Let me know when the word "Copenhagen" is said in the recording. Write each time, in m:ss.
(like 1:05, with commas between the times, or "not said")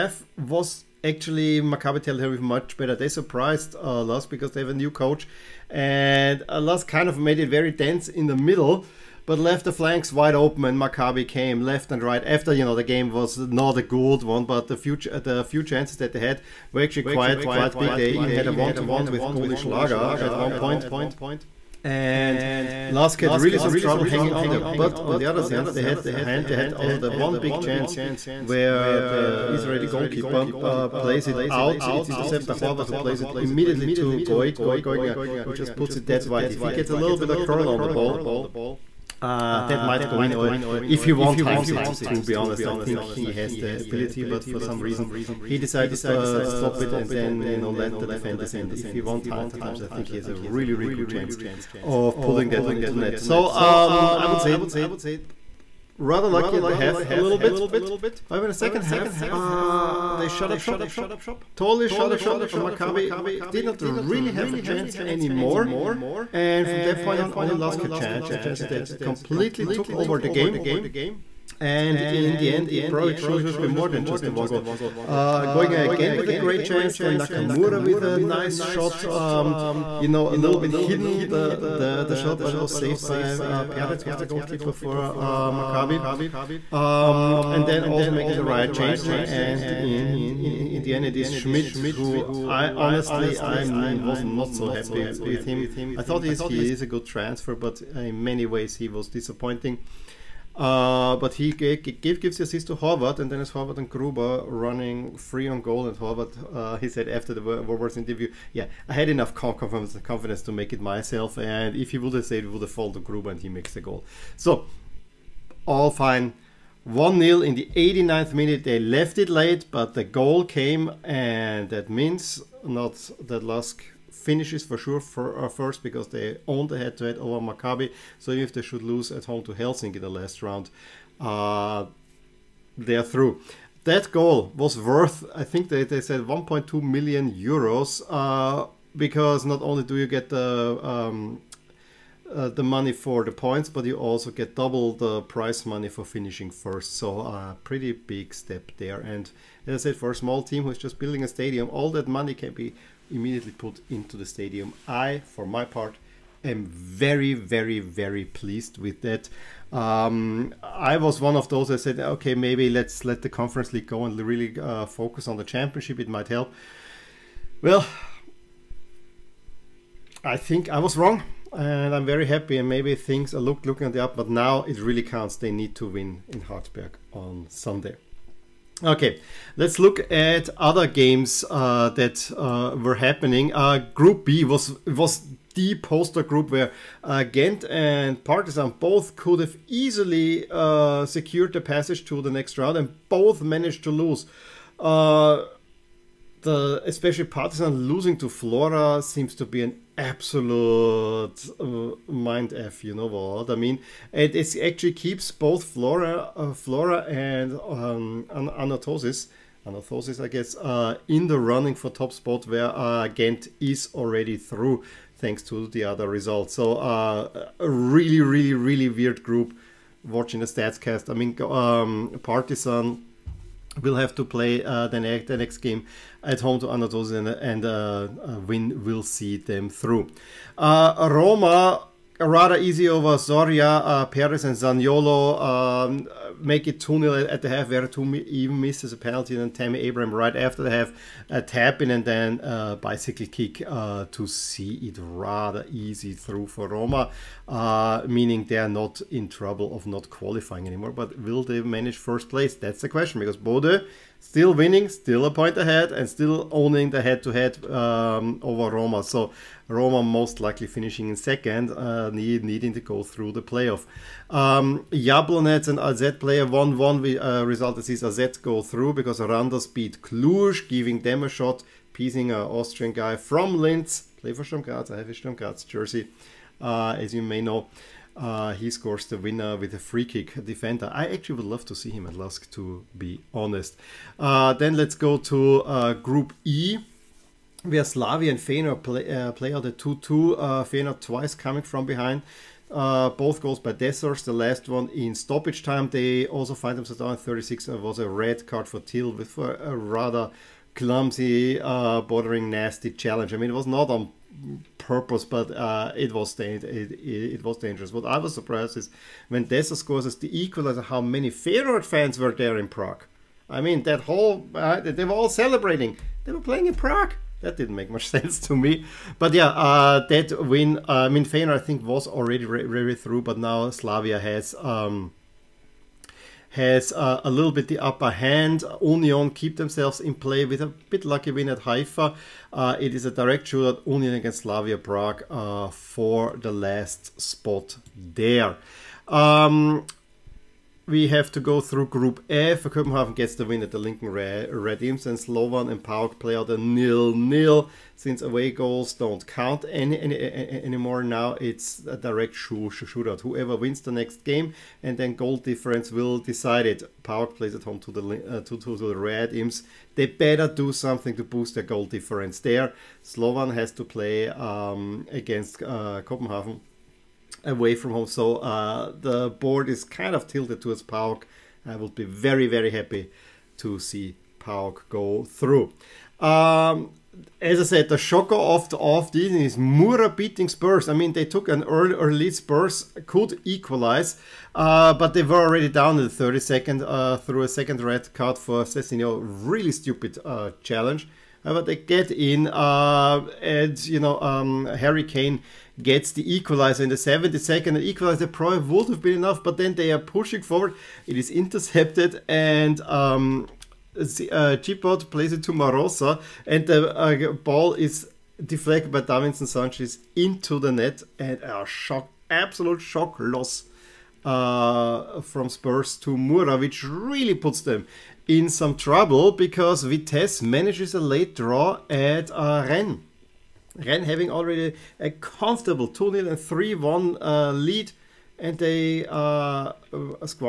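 5:42, 6:06.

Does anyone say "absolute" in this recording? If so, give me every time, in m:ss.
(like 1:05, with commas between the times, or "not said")
3:19, 6:52.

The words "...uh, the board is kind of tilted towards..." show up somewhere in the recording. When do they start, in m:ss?
6:08.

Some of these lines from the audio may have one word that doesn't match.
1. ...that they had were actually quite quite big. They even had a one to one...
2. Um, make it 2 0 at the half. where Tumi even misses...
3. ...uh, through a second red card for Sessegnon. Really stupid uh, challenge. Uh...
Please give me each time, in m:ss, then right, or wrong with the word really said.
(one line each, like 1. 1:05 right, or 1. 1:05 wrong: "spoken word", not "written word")
1. 0:15 right
2. 3:55 right
3. 6:26 right.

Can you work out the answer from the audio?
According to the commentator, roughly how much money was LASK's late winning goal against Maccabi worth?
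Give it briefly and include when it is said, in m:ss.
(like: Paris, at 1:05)
1.2 million euros, at 2:16.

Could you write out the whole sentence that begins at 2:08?
So even if they should lose at home to Helsinki in the last round, uh, they are through.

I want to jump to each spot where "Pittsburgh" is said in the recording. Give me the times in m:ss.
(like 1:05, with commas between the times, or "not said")
not said.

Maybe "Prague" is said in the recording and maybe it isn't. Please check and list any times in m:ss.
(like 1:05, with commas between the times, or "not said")
5:12, 5:16, 5:34.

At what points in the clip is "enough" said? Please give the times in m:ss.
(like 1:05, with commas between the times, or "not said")
1:49, 6:39.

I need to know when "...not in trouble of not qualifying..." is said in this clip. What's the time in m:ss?
4:08.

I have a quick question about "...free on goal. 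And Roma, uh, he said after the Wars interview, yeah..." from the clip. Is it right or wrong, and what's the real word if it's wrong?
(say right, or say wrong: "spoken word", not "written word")
wrong: "Horvath", not "Roma".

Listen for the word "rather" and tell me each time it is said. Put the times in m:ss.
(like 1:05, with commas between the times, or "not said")
0:55, 3:52, 4:04, 4:59.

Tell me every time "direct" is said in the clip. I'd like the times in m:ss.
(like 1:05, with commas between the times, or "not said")
5:33, 5:51.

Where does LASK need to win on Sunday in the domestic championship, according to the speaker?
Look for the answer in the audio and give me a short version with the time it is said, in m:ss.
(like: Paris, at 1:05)
Hartberg, at 2:56.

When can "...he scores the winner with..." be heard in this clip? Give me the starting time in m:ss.
4:38.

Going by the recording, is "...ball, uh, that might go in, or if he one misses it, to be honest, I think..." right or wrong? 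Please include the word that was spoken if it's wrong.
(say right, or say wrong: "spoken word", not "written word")
wrong: "times", not "misses".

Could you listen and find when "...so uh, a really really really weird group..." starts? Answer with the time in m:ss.
3:36.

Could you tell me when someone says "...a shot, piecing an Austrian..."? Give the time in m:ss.
4:31.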